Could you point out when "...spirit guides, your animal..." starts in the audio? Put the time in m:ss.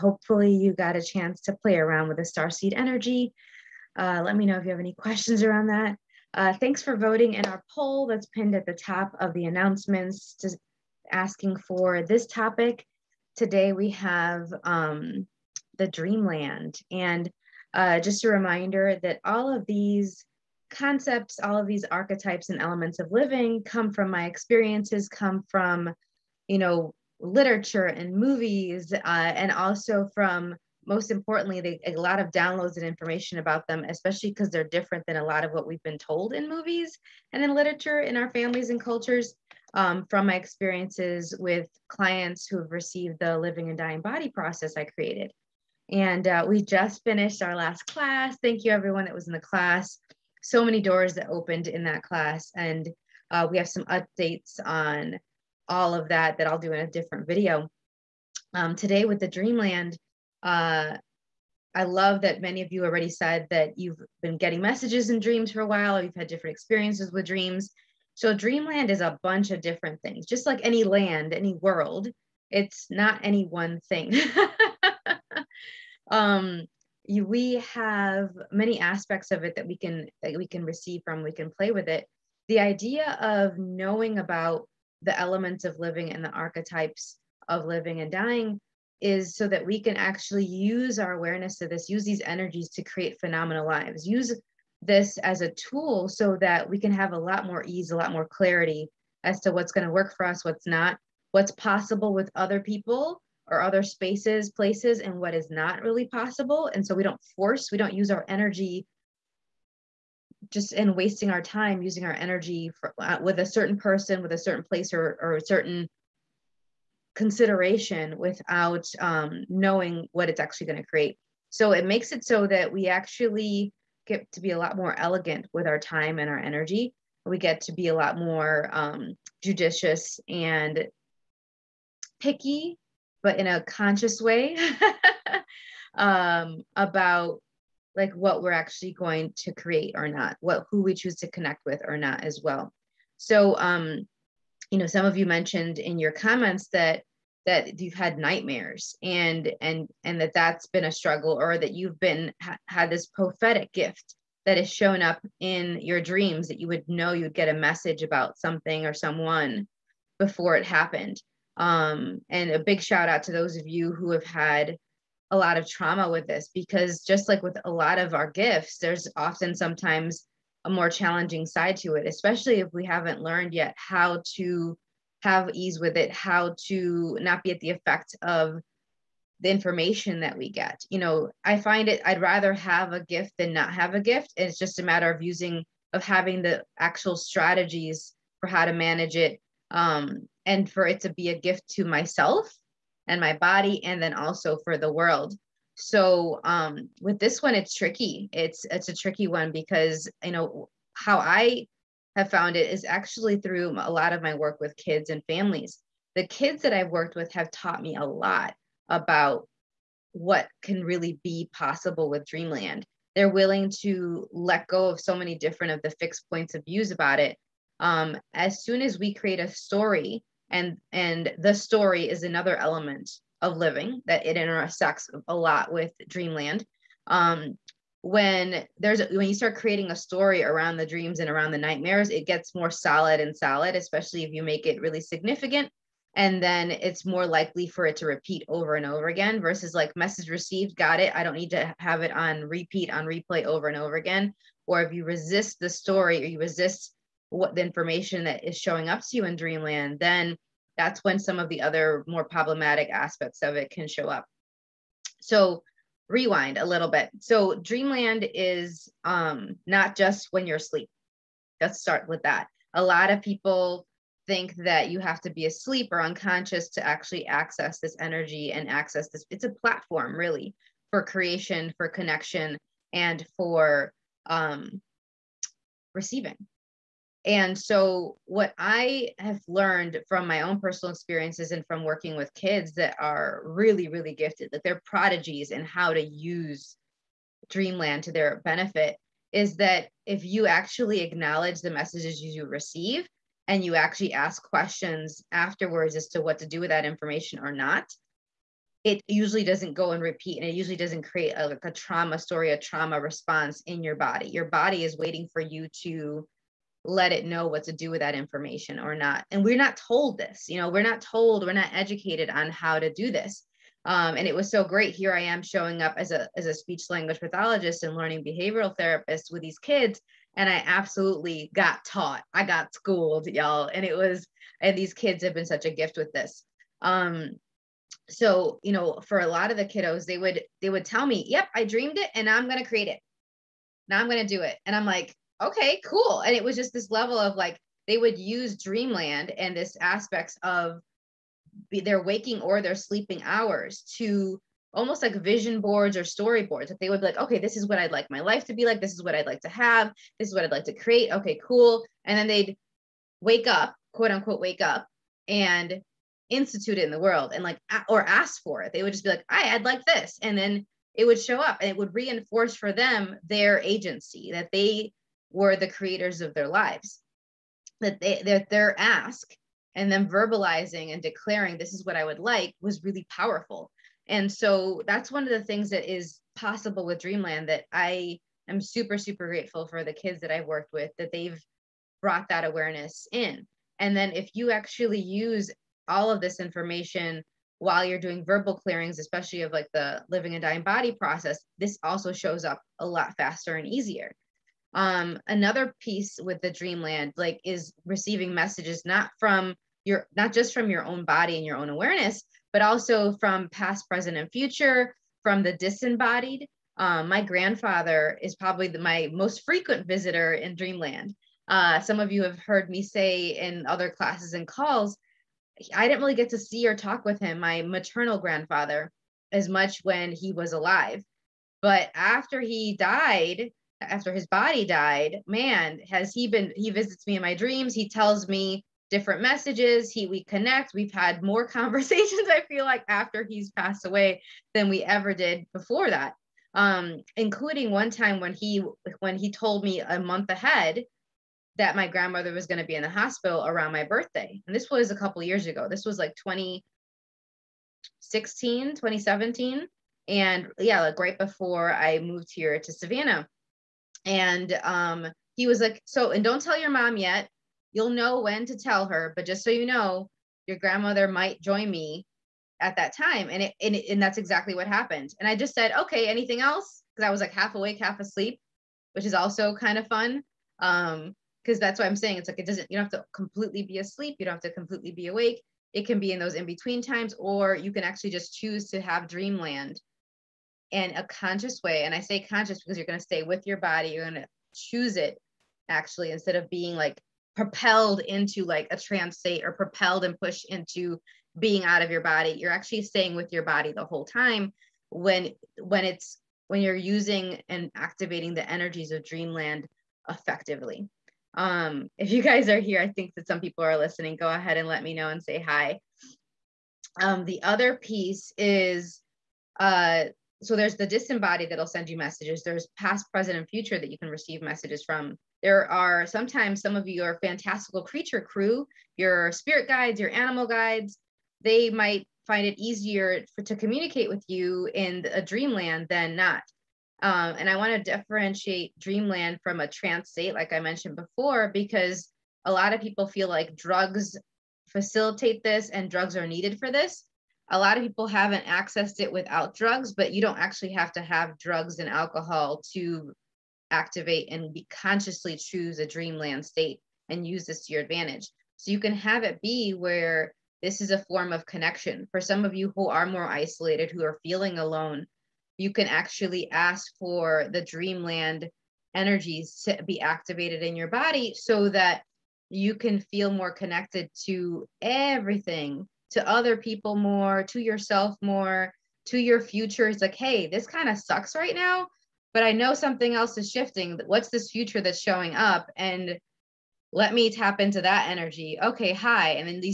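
8:39.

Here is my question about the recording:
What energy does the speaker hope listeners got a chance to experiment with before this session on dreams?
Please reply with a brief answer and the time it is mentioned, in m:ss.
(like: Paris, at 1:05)
star seed energy, at 0:02.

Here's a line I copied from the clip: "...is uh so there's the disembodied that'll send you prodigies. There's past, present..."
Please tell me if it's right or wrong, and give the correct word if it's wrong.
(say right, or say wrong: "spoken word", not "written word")
wrong: "messages", not "prodigies".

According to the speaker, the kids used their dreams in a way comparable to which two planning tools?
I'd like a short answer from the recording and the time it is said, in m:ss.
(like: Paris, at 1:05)
vision boards or storyboards, at 5:45.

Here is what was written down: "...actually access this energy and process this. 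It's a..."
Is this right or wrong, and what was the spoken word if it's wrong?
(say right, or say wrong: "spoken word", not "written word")
wrong: "access", not "process".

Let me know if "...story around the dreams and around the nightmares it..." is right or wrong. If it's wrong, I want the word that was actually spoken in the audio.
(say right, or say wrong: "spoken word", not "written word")
right.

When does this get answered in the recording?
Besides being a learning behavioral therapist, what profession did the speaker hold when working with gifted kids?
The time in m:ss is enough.
5:16.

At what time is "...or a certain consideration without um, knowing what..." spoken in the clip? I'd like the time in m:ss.
1:55.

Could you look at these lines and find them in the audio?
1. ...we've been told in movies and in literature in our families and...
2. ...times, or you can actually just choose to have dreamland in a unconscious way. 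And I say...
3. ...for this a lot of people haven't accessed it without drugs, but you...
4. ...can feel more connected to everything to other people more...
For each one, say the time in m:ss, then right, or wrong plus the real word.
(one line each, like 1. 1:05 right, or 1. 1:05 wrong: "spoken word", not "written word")
1. 0:35 right
2. 7:56 wrong: "conscious", not "unconscious"
3. 8:56 right
4. 9:22 right.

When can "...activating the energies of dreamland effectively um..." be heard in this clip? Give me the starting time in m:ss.
8:17.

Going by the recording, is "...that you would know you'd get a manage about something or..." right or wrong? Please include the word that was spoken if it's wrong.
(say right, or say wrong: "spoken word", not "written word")
wrong: "message", not "manage".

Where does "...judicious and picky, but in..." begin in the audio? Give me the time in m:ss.
2:09.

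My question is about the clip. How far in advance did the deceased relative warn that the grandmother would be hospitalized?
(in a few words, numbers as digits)
a month.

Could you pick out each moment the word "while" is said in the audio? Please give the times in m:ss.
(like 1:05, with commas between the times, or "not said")
1:05, 6:27.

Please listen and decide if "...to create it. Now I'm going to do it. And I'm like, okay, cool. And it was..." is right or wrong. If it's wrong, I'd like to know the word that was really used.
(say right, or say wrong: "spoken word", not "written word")
right.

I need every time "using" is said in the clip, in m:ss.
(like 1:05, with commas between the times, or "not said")
1:51, 3:05, 8:16.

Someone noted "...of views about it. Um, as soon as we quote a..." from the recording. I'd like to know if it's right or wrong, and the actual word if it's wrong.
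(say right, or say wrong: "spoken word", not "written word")
wrong: "create", not "quote".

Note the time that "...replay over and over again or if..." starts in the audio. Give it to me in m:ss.
4:03.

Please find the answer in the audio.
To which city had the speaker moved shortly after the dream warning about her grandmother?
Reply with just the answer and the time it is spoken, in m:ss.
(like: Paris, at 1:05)
Savannah, at 7:32.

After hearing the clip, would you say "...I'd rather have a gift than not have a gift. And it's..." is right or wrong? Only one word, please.
right.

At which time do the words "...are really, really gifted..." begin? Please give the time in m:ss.
4:42.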